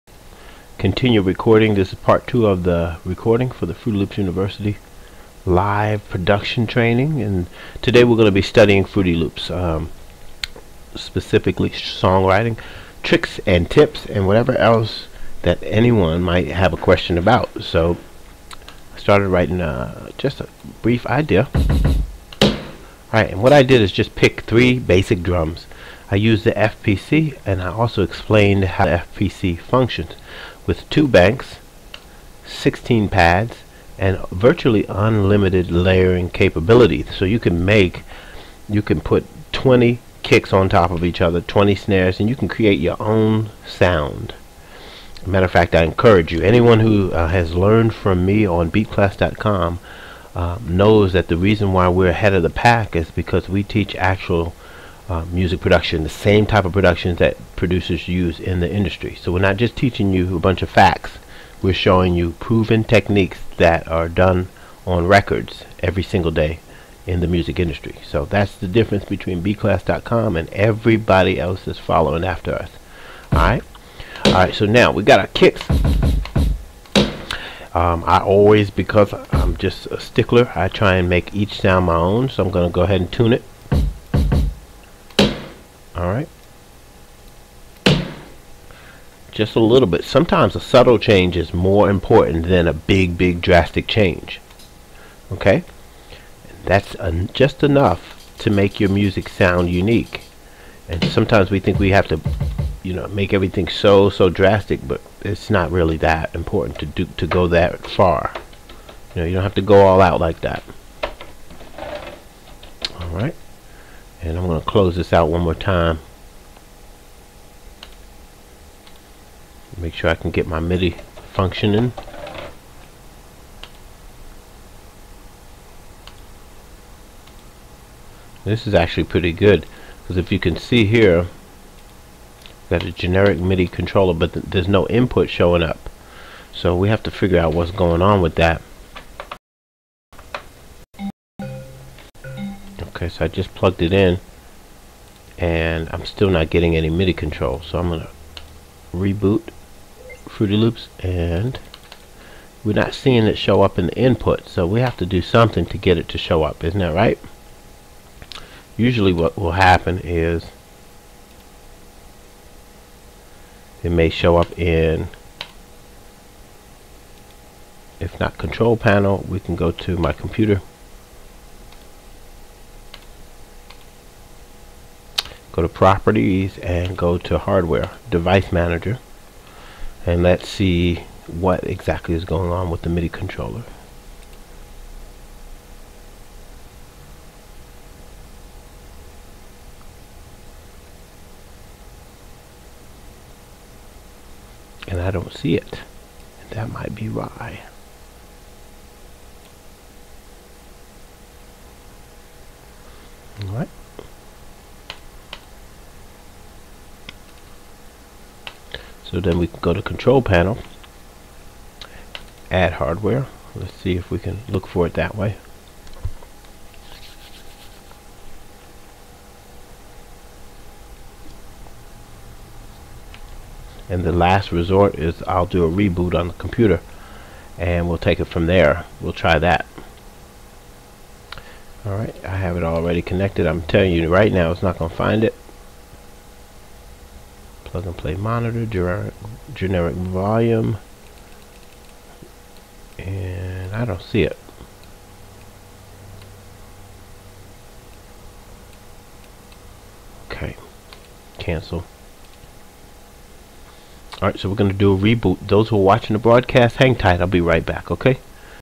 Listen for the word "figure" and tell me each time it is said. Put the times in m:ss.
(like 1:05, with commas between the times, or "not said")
2:17.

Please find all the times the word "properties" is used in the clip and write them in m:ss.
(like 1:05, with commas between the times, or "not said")
2:55.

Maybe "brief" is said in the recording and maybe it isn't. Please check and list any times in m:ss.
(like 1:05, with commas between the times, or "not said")
0:20.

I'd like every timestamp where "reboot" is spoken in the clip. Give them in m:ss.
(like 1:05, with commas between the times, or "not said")
2:28, 3:45, 4:14.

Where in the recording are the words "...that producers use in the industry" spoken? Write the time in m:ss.
0:57.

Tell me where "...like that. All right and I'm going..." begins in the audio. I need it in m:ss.
1:50.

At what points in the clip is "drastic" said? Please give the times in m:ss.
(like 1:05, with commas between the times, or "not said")
1:33, 1:44.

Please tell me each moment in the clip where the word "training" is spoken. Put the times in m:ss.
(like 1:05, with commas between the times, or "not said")
0:06.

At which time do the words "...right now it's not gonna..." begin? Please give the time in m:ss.
3:54.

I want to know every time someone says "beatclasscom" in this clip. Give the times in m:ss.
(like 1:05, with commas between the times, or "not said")
0:48, 1:09.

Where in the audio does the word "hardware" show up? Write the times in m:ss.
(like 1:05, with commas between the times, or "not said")
2:57, 3:32.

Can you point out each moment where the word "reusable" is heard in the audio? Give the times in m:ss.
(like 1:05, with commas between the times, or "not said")
not said.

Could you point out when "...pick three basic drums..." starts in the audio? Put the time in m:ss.
0:24.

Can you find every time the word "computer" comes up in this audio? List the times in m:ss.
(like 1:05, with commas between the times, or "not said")
2:50, 3:46.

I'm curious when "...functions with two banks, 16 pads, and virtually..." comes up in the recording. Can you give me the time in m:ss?
0:29.